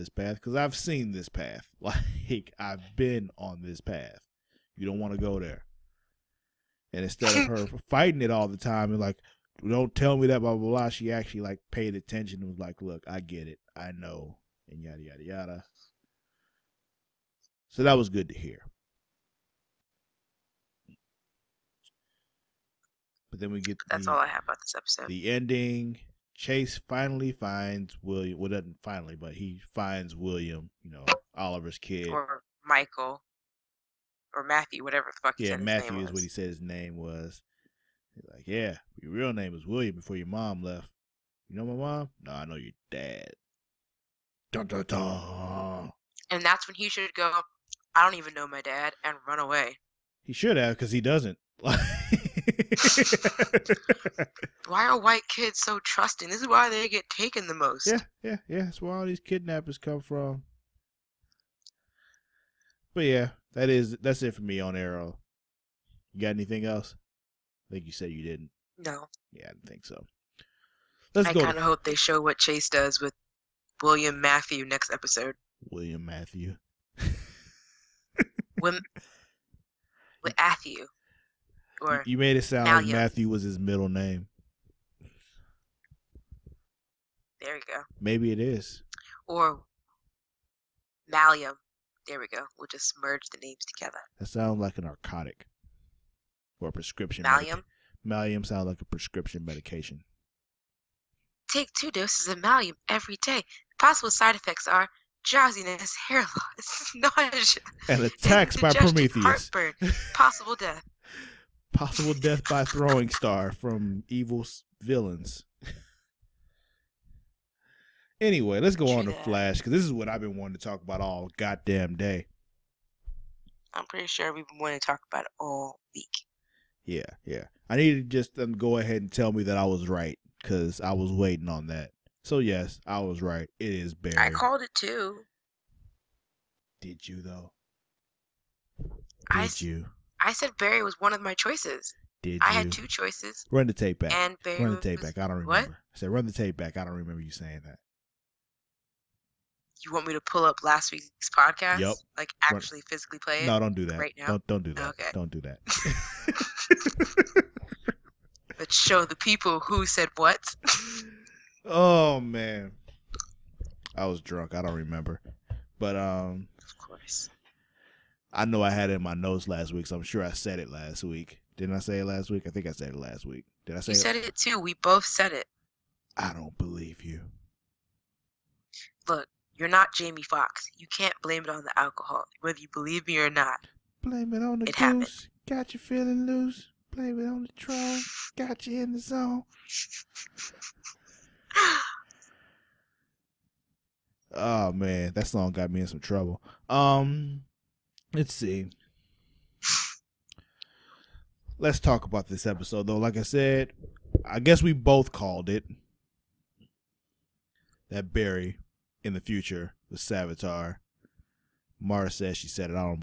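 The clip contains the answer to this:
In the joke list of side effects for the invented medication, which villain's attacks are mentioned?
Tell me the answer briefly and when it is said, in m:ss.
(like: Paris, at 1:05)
Prometheus, at 1:48.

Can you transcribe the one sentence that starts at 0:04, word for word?
You don't want to go there.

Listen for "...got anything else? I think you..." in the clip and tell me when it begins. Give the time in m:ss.
1:06.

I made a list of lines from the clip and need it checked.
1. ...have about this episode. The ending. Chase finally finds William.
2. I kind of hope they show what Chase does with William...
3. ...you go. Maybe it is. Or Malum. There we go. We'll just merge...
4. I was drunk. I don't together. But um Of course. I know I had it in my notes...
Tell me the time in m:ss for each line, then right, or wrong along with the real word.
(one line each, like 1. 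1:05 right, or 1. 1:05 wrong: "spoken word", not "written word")
1. 0:24 right
2. 1:11 right
3. 1:27 right
4. 2:43 wrong: "remember", not "together".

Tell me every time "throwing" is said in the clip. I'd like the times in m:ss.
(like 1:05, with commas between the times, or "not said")
1:52.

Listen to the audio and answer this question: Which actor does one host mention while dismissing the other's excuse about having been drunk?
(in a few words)
Jamie Foxx.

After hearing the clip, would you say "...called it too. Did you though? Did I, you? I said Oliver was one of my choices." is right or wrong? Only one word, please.
wrong.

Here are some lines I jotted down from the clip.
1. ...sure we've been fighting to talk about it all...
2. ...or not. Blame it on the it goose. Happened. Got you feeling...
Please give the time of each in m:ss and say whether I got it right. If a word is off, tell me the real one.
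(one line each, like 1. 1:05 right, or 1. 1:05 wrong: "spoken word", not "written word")
1. 2:04 wrong: "wanting", not "fighting"
2. 3:03 right.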